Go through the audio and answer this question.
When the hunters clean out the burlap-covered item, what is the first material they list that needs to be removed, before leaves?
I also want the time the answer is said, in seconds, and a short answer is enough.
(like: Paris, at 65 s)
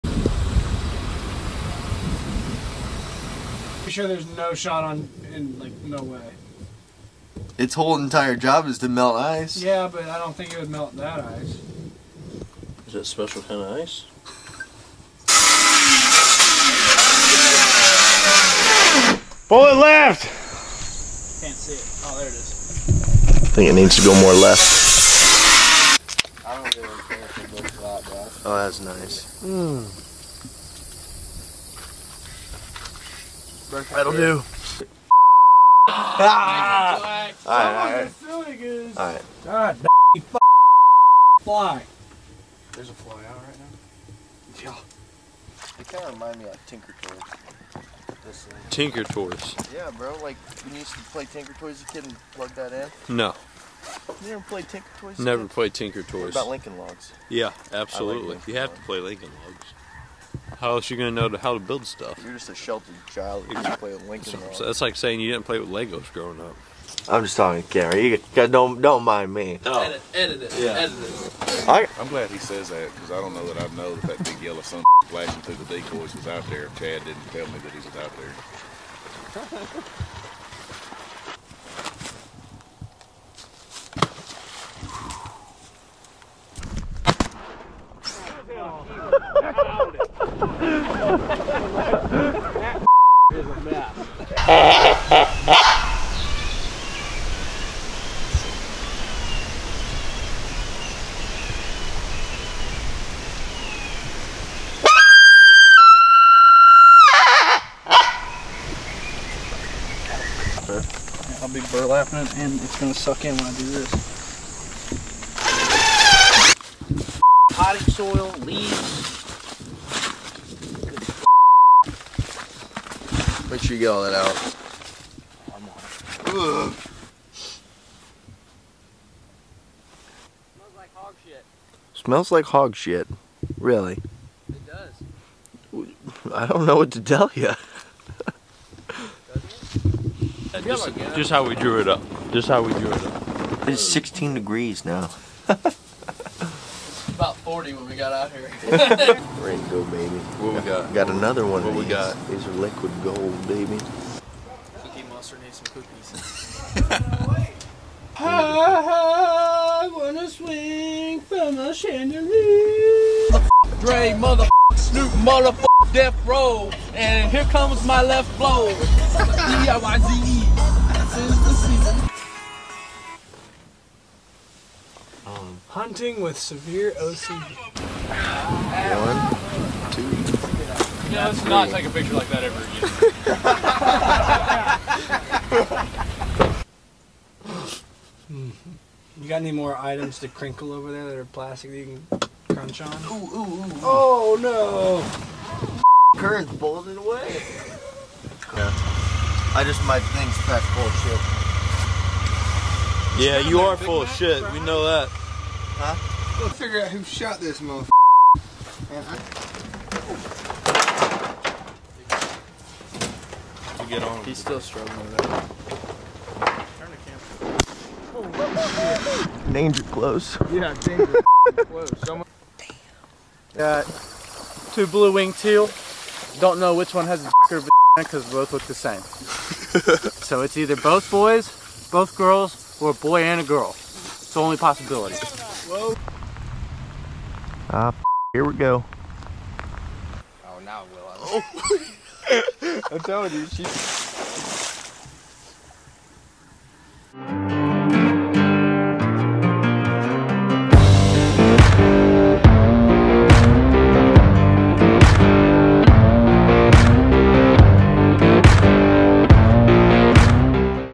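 Potting soil, at 117 s.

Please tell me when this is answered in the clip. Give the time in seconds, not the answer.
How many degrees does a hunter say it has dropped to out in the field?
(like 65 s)
143 s.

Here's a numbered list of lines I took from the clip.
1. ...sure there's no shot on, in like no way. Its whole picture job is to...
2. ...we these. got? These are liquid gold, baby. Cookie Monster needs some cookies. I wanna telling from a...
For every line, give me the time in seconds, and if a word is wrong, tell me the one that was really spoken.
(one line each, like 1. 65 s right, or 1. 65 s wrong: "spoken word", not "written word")
1. 4 s wrong: "entire", not "picture"
2. 151 s wrong: "swing", not "telling".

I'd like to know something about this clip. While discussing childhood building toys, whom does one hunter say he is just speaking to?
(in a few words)
Gary.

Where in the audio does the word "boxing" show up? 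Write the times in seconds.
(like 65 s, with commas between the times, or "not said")
not said.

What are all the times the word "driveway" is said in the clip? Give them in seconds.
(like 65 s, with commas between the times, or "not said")
not said.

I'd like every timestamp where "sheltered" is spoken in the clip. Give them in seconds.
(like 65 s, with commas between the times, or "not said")
62 s.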